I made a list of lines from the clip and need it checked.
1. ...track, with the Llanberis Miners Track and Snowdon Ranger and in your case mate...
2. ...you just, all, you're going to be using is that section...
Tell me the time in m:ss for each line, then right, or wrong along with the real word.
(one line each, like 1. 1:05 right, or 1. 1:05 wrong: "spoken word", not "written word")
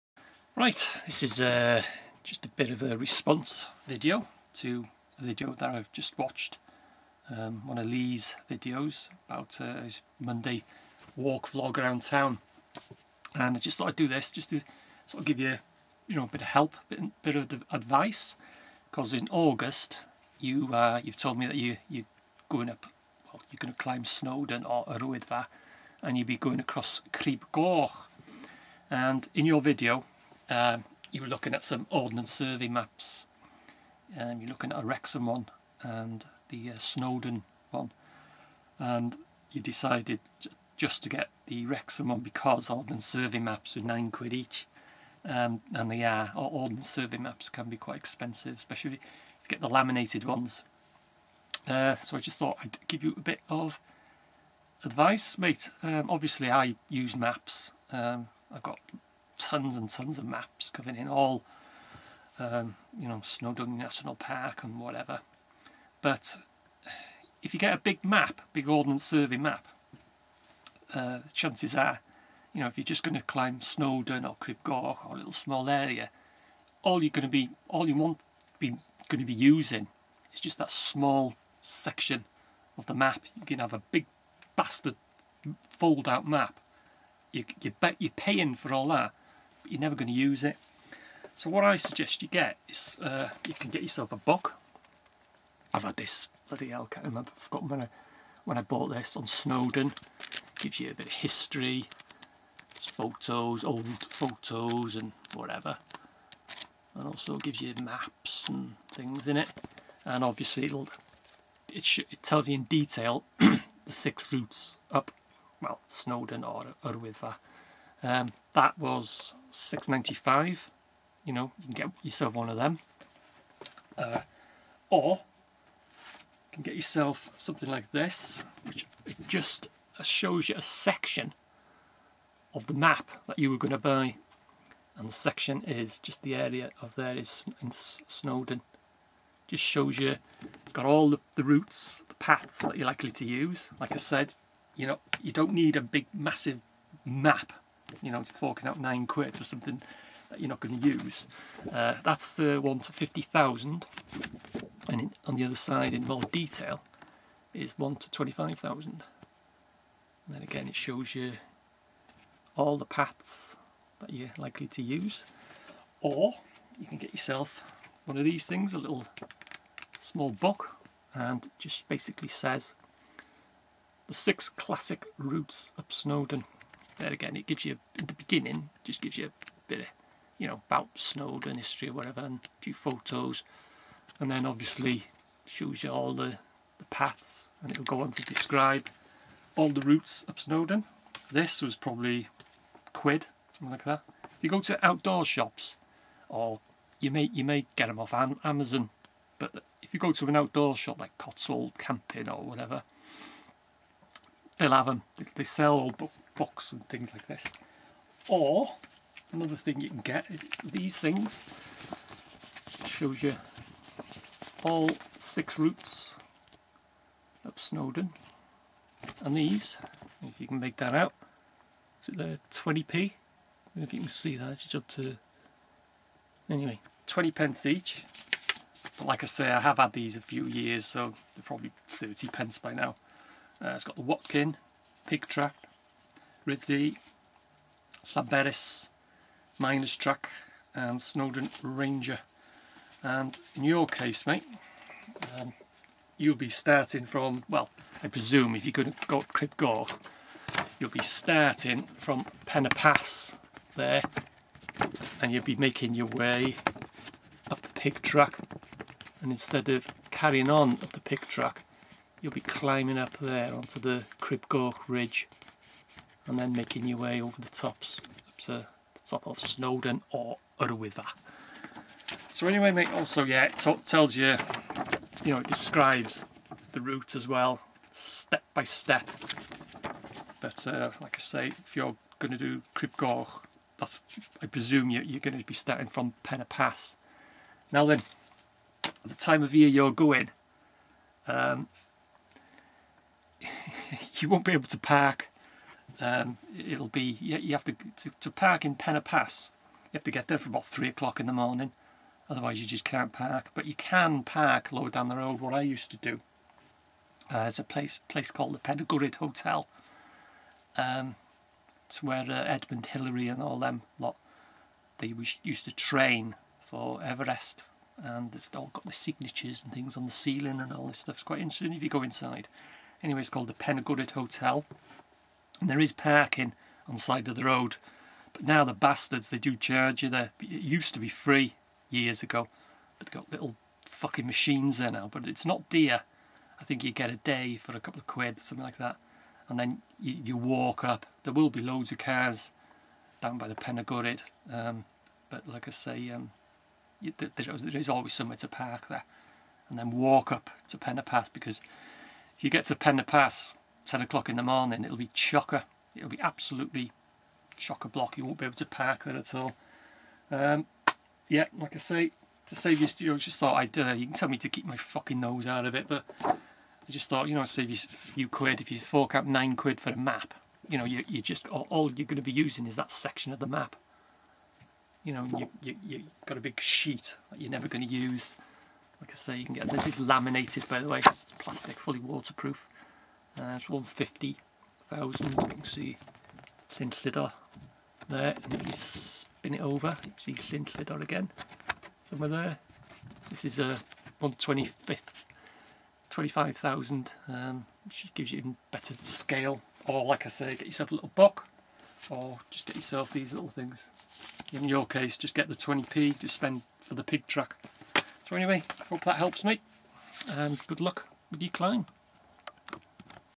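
1. 3:55 right
2. 6:11 right.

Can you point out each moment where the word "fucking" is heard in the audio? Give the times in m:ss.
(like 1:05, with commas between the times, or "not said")
5:33, 6:04.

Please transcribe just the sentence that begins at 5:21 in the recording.
It's quite interesting if you go inside.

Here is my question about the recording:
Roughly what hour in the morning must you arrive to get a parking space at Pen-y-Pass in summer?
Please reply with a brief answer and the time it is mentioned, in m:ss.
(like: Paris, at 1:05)
3 o'clock, at 5:00.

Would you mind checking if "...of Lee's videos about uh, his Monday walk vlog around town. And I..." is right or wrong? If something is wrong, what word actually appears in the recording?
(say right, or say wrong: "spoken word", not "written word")
right.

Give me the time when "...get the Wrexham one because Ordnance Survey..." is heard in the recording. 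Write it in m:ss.
0:41.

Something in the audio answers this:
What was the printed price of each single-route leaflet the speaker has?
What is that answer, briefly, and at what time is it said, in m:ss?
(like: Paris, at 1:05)
20 pence, at 3:47.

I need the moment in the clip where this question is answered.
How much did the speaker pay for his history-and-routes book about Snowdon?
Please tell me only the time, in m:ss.
1:59.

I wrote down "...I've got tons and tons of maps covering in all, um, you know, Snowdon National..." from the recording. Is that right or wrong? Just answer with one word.
right.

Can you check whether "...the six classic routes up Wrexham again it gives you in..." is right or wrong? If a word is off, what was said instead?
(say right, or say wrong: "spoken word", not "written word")
wrong: "Snowdon", not "Wrexham".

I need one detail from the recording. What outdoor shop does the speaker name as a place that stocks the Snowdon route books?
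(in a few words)
Cotswold Camping.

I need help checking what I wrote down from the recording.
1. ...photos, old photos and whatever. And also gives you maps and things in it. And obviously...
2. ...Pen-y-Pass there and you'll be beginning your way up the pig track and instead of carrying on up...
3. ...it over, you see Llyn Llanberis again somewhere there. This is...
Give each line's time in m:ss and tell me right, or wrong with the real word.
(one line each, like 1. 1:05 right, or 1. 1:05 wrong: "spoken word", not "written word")
1. 1:42 right
2. 4:12 wrong: "making", not "beginning"
3. 6:29 wrong: "Llydaw", not "Llanberis".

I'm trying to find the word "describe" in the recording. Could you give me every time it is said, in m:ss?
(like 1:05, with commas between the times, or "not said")
3:08, 4:35.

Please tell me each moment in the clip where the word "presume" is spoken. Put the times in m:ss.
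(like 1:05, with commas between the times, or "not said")
4:08, 4:44.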